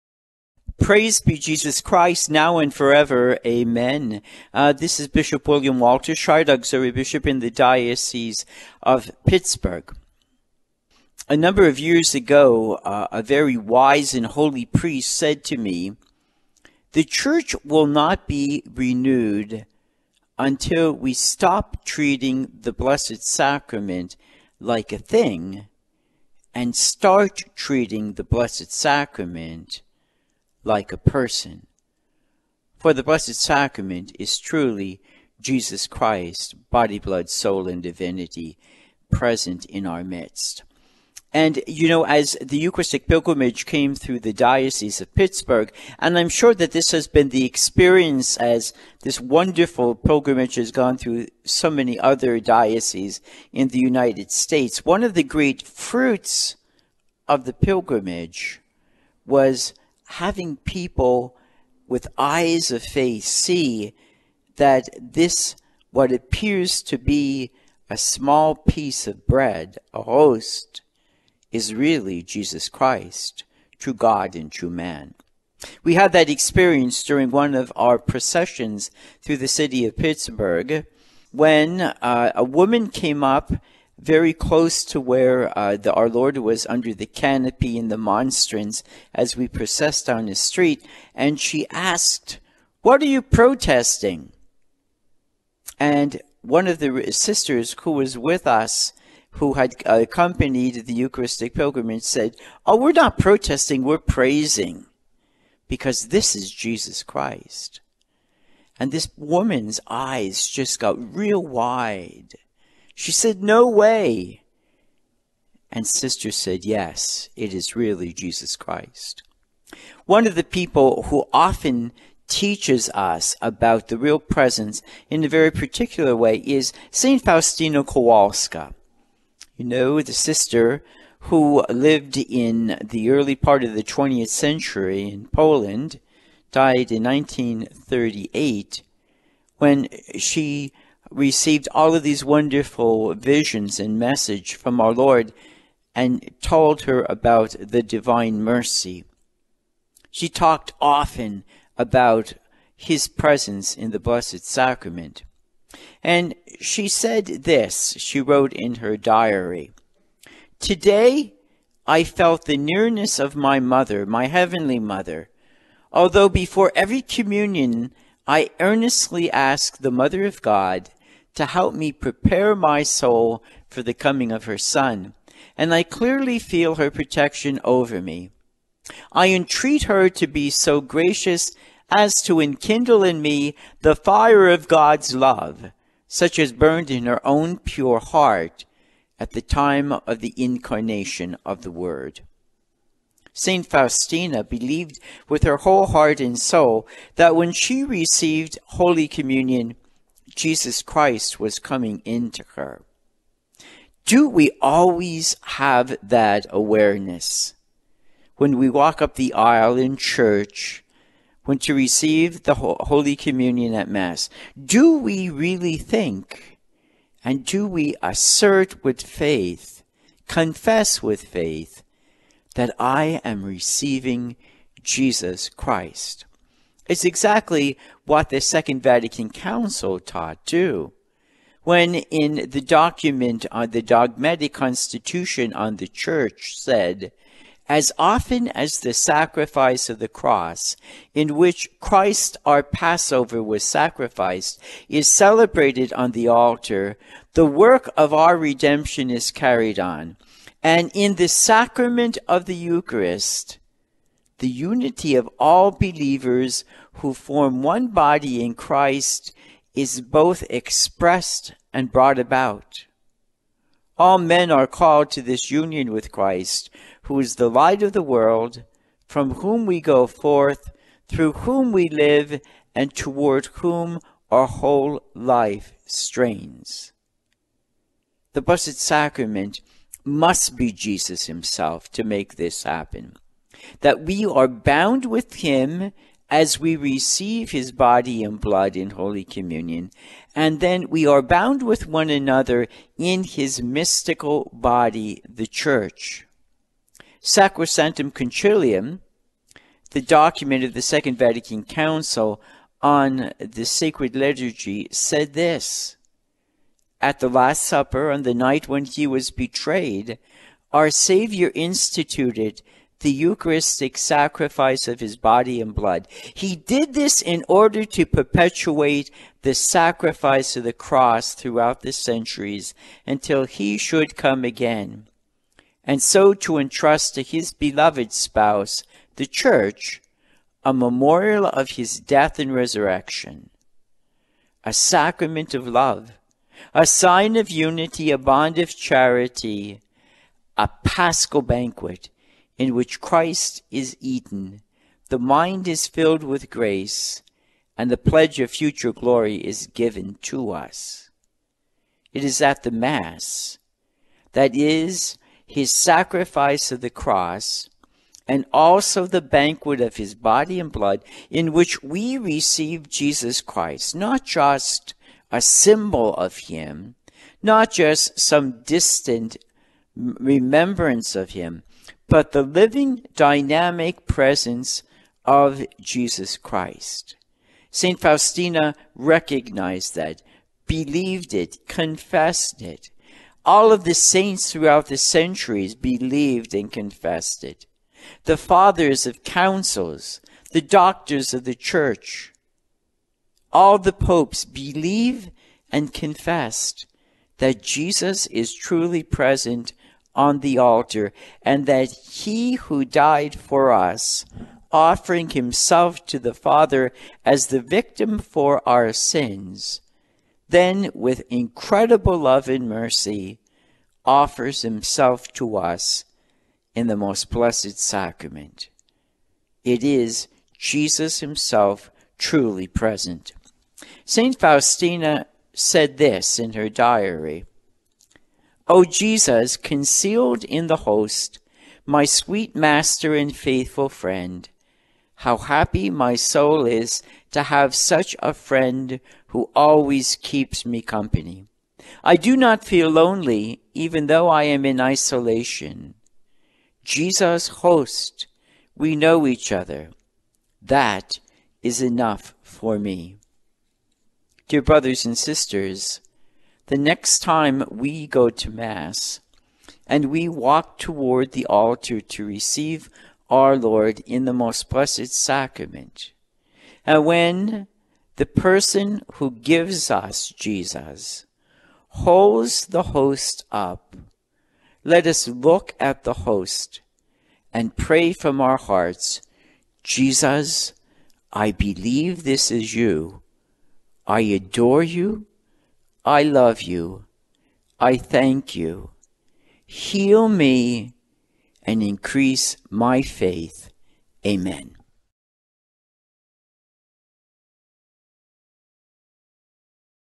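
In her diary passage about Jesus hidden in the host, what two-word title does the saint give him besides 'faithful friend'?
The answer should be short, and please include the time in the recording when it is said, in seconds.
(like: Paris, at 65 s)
Sweet master, at 432 s.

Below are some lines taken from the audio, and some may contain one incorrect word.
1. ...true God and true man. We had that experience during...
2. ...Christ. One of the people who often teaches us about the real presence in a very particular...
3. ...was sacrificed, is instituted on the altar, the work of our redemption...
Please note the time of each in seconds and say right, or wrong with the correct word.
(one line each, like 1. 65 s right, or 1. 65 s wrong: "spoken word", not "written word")
1. 73 s right
2. 118 s right
3. 243 s wrong: "celebrated", not "instituted".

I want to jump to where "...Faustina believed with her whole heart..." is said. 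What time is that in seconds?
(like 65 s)
193 s.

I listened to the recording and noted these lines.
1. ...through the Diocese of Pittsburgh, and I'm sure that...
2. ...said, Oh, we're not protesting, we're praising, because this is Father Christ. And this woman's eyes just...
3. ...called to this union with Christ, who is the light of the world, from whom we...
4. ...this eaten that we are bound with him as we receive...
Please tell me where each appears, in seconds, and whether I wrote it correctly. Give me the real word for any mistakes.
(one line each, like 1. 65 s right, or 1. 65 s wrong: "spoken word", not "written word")
1. 43 s right
2. 102 s wrong: "Jesus", not "Father"
3. 264 s right
4. 282 s wrong: "happen", not "eaten".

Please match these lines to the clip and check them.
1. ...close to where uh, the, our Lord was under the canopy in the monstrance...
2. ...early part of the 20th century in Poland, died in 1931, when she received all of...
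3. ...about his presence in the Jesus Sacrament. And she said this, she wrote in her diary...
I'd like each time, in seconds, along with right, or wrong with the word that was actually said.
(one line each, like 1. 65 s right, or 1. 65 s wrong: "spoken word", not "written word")
1. 84 s right
2. 133 s wrong: "1938", not "1931"
3. 151 s wrong: "Blessed", not "Jesus".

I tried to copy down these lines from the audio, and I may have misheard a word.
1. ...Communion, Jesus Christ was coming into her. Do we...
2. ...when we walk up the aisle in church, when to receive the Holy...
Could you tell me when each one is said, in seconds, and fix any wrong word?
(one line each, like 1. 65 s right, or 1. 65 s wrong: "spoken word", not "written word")
1. 199 s right
2. 208 s right.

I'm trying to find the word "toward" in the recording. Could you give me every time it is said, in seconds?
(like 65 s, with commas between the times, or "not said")
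272 s, 460 s.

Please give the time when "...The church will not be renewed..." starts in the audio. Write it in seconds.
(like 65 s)
16 s.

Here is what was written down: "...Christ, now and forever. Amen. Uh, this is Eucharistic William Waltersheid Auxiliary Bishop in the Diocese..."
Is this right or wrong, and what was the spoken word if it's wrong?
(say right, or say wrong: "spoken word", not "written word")
wrong: "Bishop", not "Eucharistic".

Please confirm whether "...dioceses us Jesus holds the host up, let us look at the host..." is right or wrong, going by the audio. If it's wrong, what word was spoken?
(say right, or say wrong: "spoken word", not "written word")
wrong: "gives", not "dioceses".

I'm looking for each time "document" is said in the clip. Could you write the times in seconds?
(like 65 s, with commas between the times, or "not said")
232 s, 300 s.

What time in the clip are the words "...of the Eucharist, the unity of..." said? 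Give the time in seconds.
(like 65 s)
252 s.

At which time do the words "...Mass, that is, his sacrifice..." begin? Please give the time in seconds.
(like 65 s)
352 s.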